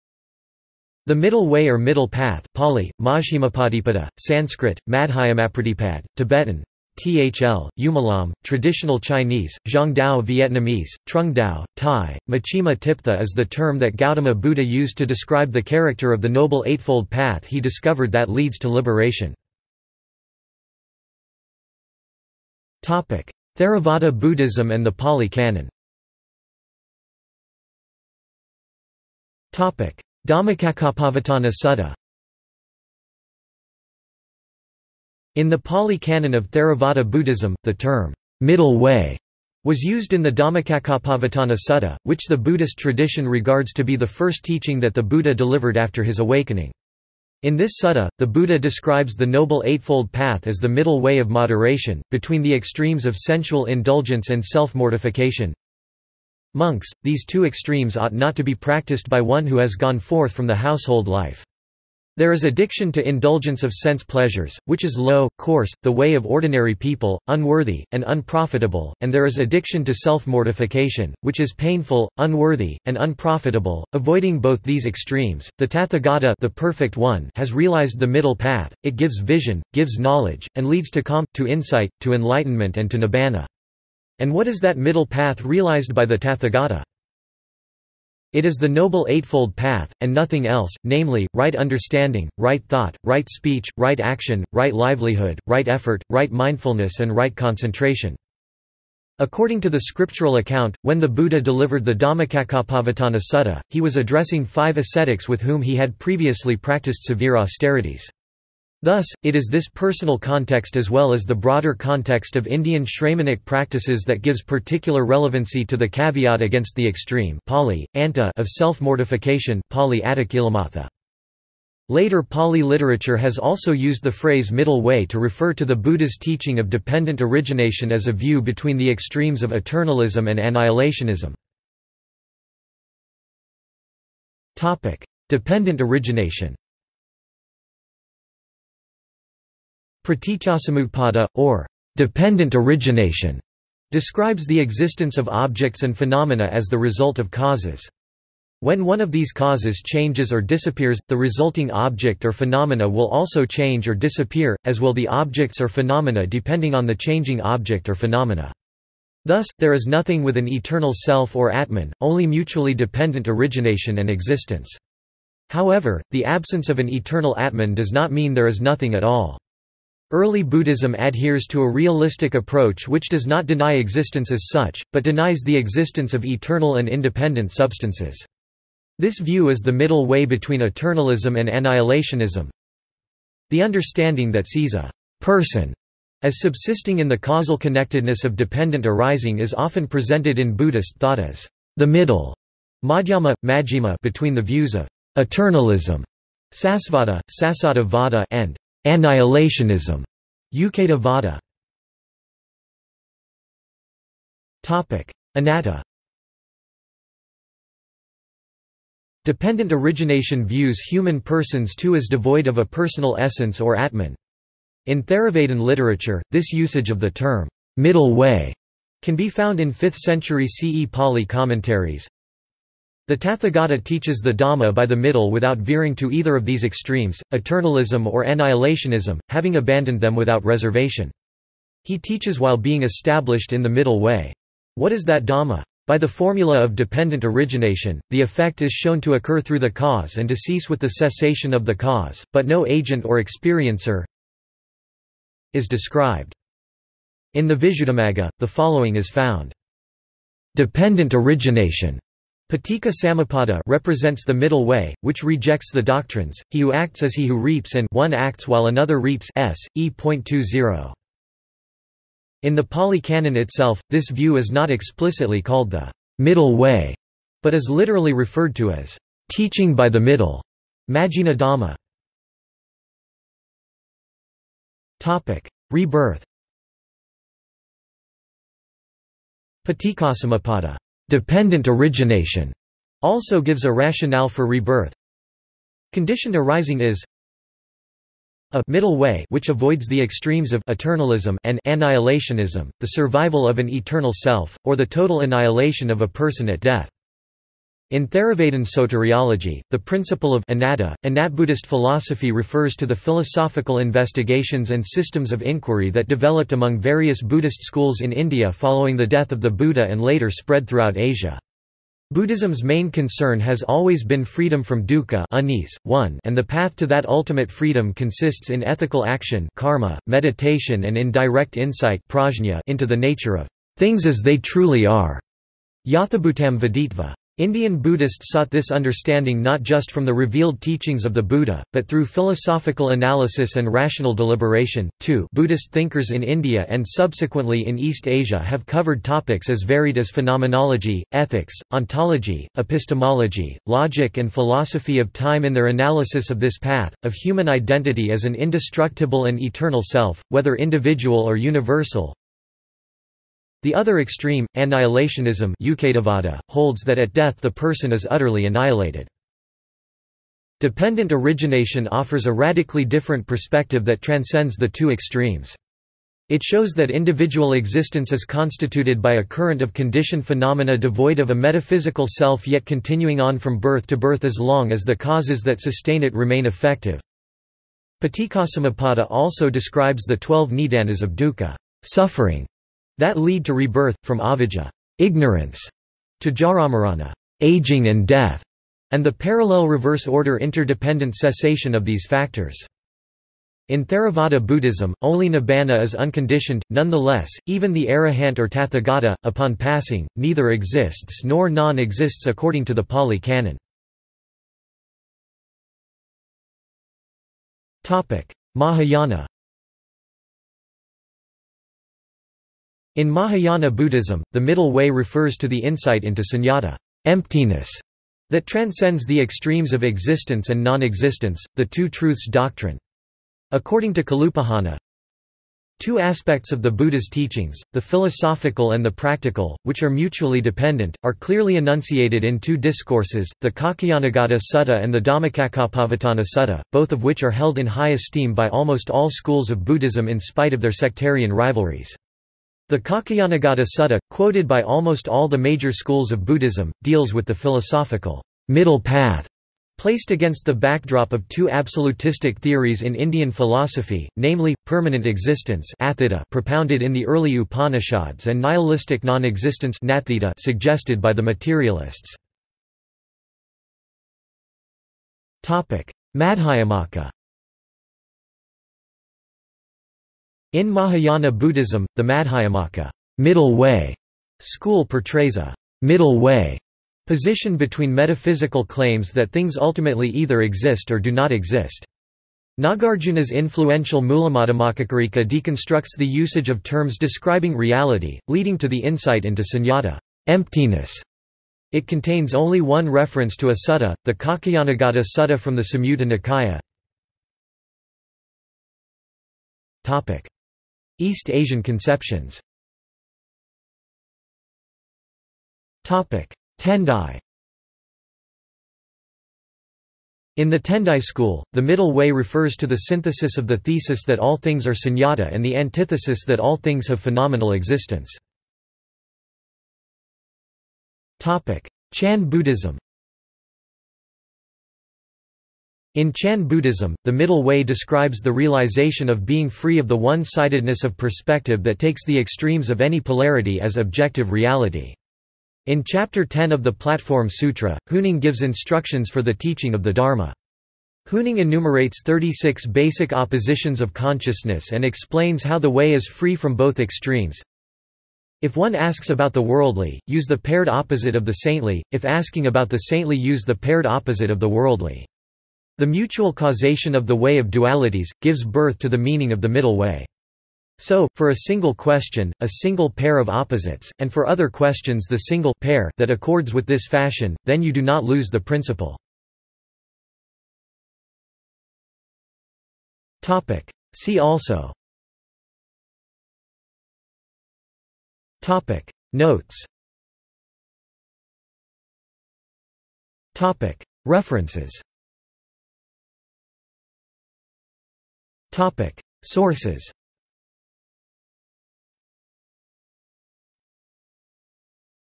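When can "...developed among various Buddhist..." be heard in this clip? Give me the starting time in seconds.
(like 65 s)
306 s.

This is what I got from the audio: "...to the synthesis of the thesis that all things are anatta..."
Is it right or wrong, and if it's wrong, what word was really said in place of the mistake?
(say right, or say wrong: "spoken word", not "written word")
wrong: "sunyata", not "anatta".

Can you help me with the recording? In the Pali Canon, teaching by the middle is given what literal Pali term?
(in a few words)
Majjhima Dhamma.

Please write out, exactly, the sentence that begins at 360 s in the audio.
Dependent origination offers a radically different perspective that transcends the two extremes.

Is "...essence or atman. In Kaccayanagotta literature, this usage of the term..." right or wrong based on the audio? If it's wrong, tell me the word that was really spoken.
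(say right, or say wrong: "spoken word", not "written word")
wrong: "Theravada", not "Kaccayanagotta".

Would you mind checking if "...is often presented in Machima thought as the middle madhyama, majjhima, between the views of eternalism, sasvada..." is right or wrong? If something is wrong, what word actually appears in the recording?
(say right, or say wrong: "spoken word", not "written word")
wrong: "Buddhist", not "Machima".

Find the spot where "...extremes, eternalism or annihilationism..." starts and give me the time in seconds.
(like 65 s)
226 s.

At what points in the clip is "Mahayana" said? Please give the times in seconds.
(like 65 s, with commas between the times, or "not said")
408 s, 413 s, 470 s.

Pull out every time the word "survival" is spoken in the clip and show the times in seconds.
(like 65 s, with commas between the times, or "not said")
292 s.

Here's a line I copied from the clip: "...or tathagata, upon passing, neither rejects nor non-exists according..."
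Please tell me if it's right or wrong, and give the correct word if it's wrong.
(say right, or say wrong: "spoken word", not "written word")
wrong: "exists", not "rejects".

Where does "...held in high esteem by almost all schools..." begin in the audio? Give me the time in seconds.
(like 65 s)
437 s.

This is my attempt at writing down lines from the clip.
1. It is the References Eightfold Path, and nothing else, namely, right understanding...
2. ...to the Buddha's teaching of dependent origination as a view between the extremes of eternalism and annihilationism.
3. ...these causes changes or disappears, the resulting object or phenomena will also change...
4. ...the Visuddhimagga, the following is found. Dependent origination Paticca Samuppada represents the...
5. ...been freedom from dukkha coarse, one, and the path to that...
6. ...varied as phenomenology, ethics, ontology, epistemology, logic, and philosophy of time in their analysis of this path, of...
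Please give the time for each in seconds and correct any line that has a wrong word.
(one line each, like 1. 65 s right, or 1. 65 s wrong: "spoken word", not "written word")
1. 88 s wrong: "Noble", not "References"
2. 125 s right
3. 149 s right
4. 247 s right
5. 314 s wrong: "unease", not "coarse"
6. 339 s right.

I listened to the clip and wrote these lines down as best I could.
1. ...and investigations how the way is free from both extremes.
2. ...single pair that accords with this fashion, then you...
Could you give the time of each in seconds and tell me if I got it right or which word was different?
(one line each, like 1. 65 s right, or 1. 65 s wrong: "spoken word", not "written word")
1. 544 s wrong: "explains", not "investigations"
2. 565 s right.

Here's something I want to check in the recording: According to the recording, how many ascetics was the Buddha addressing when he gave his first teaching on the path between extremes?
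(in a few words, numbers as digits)
5.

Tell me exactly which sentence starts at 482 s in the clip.
Nagarjuna's influential Mulamadhyamakakarika deconstructs the usage of terms describing reality, leading to the insight into sunyata emptiness.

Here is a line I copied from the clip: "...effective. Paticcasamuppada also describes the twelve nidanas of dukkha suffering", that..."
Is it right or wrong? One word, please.
right.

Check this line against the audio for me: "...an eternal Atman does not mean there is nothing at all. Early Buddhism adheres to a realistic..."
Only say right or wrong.
right.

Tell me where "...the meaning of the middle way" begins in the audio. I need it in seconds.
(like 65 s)
558 s.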